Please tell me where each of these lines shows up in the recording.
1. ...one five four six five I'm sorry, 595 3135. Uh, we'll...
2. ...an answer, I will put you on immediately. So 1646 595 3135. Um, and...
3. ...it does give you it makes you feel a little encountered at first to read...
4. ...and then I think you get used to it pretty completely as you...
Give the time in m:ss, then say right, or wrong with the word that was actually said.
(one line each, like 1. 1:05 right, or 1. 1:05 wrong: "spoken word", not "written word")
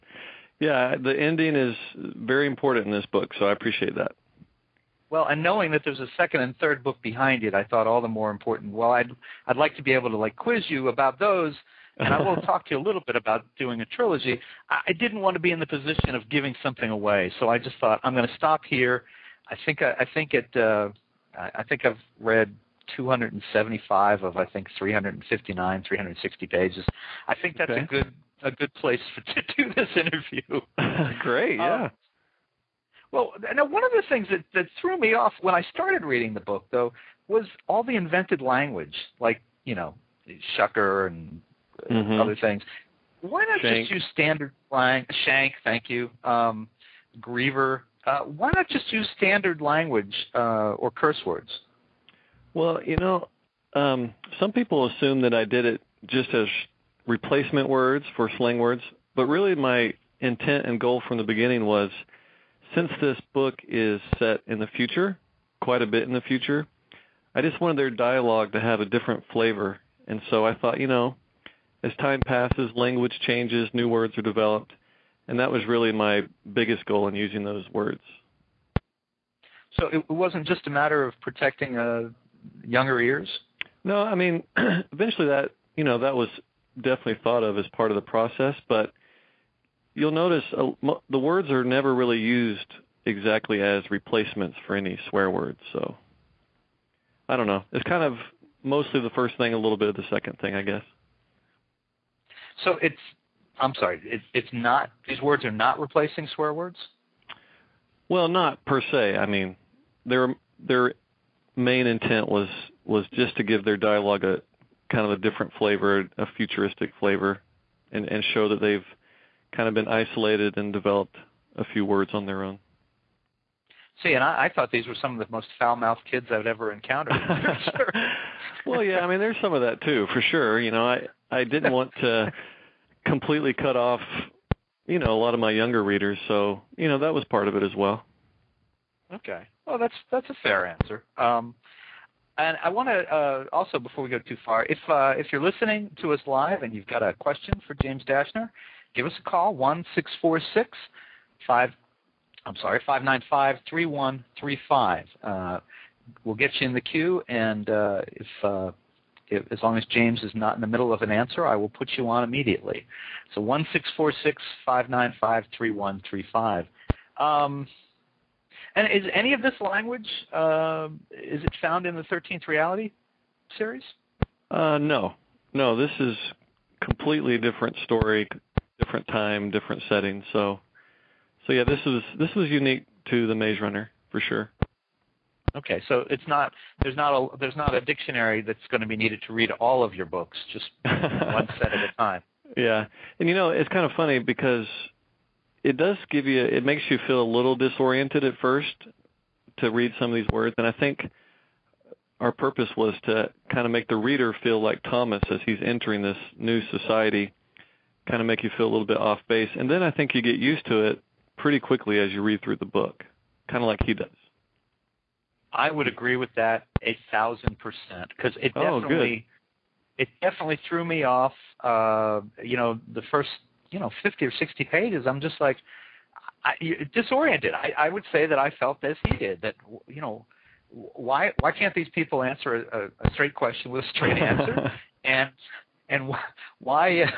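1. 2:29 wrong: "six", not "five"
2. 2:41 right
3. 3:15 wrong: "disoriented", not "encountered"
4. 3:29 wrong: "quickly", not "completely".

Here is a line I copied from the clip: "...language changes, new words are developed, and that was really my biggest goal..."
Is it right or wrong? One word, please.
right.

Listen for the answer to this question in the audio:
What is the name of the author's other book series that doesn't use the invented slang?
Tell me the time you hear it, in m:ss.
2:52.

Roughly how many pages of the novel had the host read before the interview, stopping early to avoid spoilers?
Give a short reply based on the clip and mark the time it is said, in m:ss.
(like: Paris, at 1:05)
275, at 0:22.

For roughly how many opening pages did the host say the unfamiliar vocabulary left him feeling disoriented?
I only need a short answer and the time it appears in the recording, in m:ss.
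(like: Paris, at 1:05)
50 or 60, at 3:44.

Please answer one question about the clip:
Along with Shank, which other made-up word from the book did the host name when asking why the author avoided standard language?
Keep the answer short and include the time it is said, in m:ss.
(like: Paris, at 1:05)
Griever, at 0:47.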